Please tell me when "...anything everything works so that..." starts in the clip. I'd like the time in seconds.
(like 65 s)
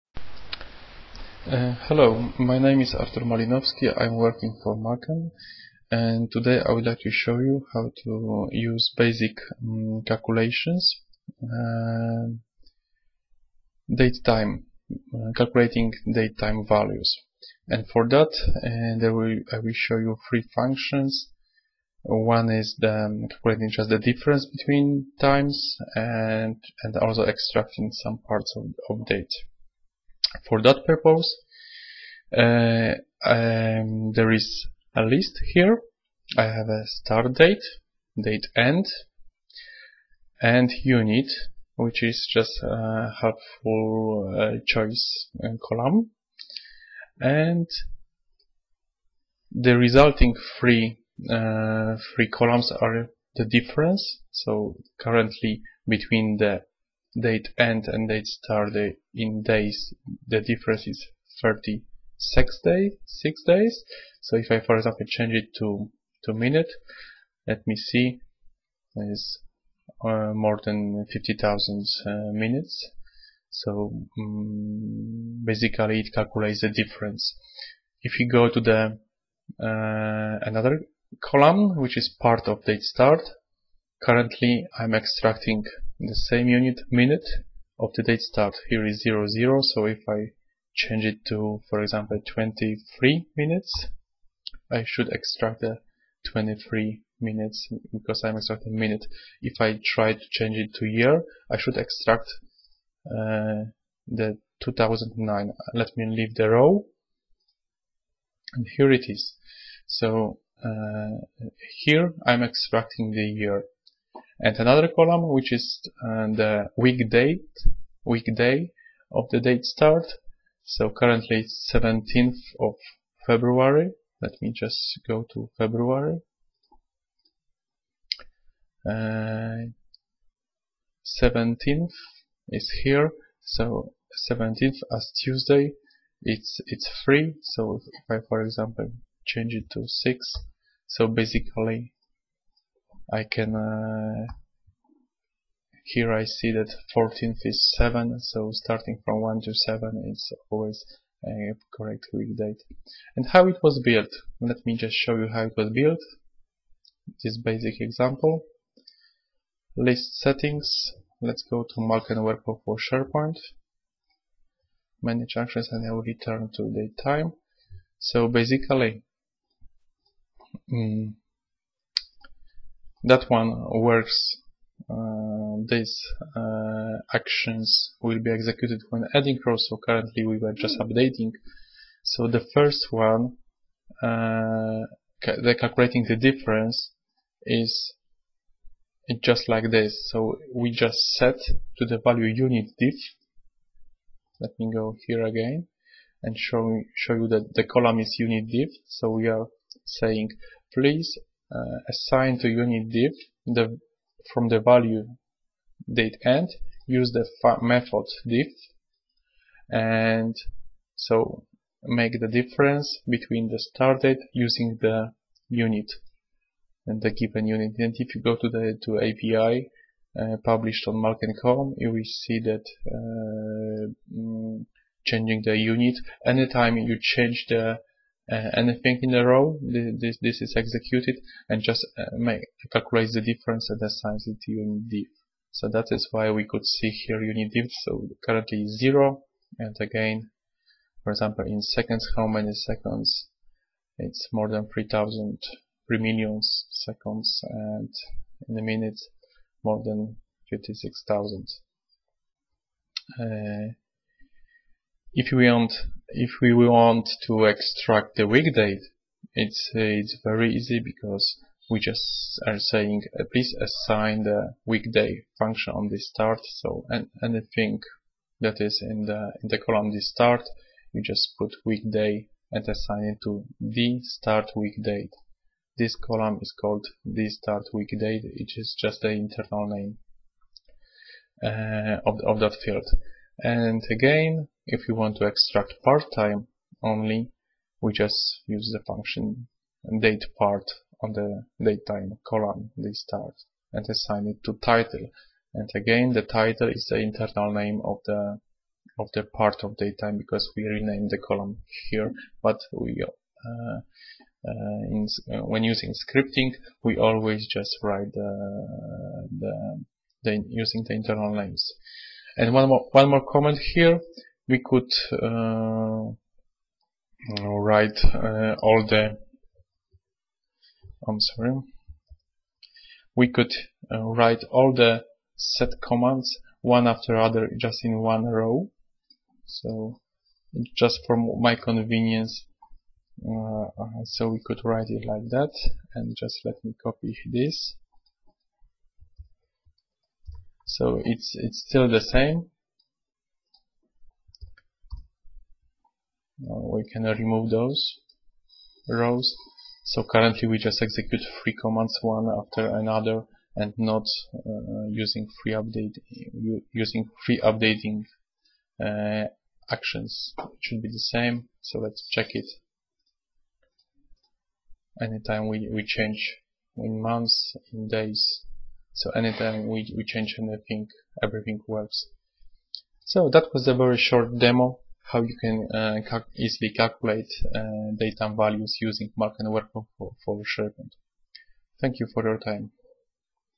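370 s.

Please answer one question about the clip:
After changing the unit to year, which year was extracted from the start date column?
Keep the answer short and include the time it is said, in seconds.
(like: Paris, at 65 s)
2009, at 104 s.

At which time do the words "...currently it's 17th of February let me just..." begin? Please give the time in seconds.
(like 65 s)
120 s.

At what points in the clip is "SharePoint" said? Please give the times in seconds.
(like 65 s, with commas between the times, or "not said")
162 s, 380 s.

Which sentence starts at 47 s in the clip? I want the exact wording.
And the resulting three, uh, three columns are the difference.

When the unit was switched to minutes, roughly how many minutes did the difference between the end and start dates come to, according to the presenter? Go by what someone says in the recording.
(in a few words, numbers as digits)
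more than 50,000.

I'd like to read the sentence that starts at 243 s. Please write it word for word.
It's more than 3000 3 million seconds and in a minute more than 56,000.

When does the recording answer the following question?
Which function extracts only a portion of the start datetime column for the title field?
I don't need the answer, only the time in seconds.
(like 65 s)
290 s.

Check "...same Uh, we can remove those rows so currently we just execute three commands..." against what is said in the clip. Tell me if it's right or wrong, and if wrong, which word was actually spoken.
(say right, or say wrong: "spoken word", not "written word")
right.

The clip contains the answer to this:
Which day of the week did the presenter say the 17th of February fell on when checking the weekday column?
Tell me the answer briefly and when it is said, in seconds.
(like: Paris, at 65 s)
Tuesday, at 135 s.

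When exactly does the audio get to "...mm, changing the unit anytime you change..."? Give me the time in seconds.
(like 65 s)
224 s.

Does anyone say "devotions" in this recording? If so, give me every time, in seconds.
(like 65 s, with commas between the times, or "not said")
not said.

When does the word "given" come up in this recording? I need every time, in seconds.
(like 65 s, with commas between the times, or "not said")
217 s.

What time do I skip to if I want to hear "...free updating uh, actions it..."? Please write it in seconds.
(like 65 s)
357 s.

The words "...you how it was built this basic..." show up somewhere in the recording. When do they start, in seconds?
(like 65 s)
155 s.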